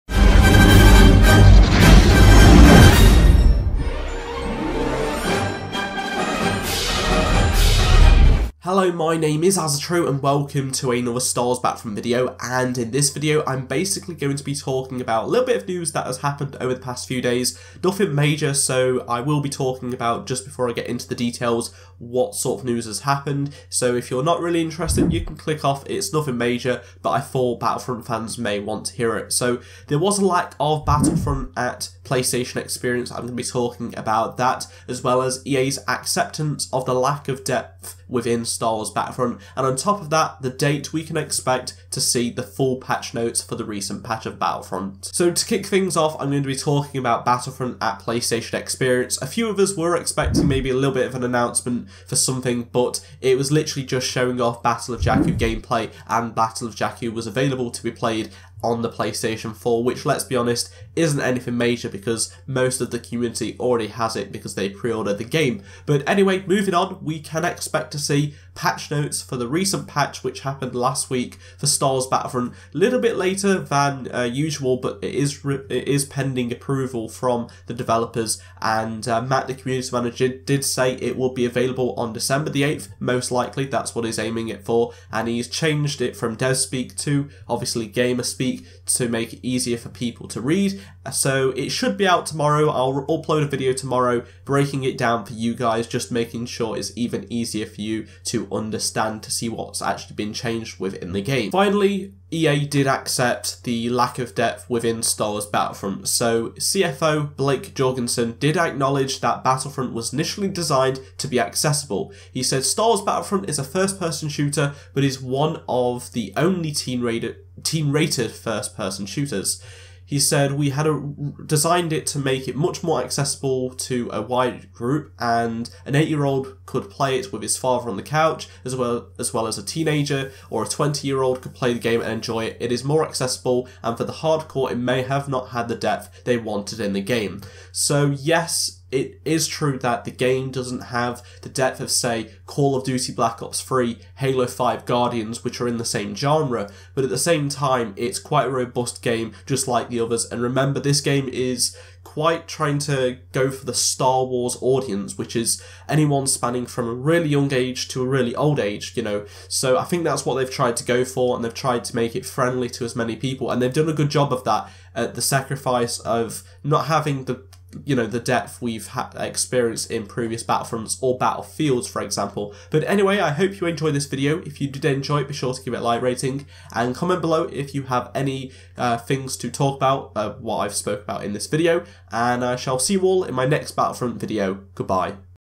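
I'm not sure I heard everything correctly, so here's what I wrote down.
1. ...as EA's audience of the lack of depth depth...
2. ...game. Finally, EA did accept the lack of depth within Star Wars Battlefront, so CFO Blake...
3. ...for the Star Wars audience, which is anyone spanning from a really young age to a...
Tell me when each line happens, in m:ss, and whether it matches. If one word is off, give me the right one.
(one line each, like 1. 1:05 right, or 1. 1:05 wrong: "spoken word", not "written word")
1. 0:35 wrong: "acceptance", not "audience"
2. 1:41 right
3. 2:33 right.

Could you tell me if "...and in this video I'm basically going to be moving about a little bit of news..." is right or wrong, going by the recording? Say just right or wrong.
wrong.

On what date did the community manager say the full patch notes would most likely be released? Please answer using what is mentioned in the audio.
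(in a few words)
December 8.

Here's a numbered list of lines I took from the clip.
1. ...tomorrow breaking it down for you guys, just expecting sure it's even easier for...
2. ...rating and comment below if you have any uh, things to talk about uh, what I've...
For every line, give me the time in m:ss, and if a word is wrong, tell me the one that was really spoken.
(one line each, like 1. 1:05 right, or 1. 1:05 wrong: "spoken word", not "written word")
1. 1:33 wrong: "making", not "expecting"
2. 2:56 right.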